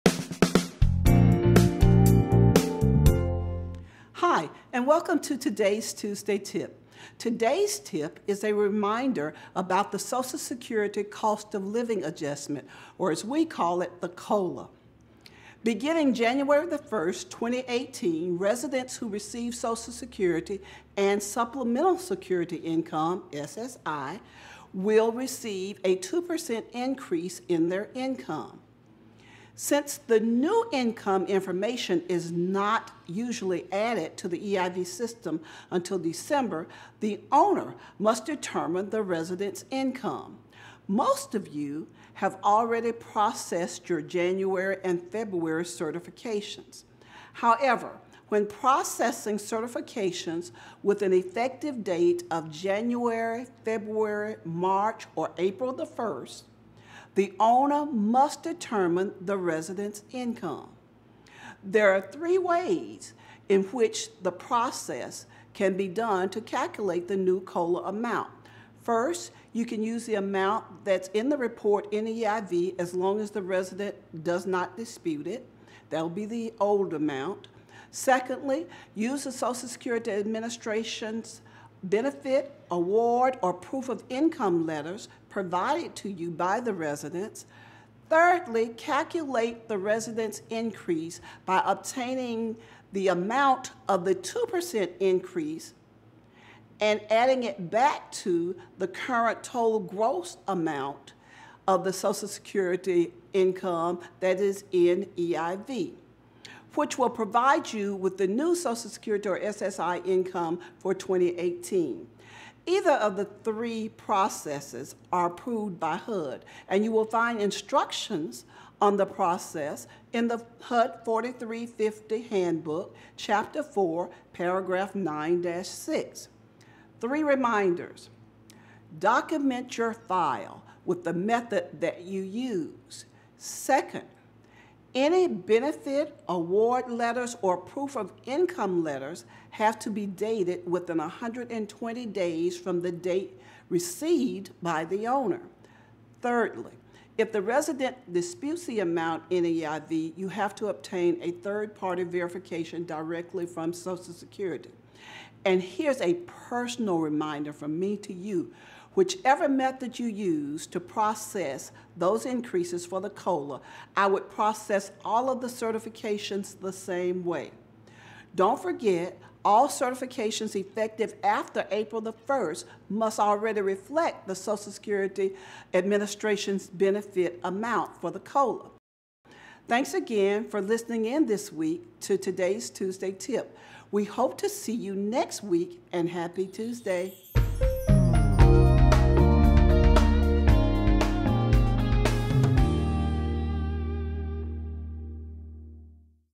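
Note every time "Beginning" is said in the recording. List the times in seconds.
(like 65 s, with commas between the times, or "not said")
15 s.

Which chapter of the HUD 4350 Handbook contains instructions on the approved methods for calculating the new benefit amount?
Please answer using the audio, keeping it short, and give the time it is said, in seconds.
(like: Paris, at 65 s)
Chapter 4, at 123 s.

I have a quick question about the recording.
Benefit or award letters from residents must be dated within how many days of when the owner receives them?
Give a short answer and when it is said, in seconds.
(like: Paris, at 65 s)
120 days, at 140 s.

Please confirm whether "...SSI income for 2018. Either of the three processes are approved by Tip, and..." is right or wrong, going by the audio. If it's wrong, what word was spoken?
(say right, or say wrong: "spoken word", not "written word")
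wrong: "HUD", not "Tip".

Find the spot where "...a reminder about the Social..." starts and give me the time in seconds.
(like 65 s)
8 s.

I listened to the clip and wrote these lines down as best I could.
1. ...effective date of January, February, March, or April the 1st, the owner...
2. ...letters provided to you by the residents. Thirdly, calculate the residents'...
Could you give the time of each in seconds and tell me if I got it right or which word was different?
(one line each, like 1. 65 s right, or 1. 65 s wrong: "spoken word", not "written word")
1. 51 s right
2. 84 s right.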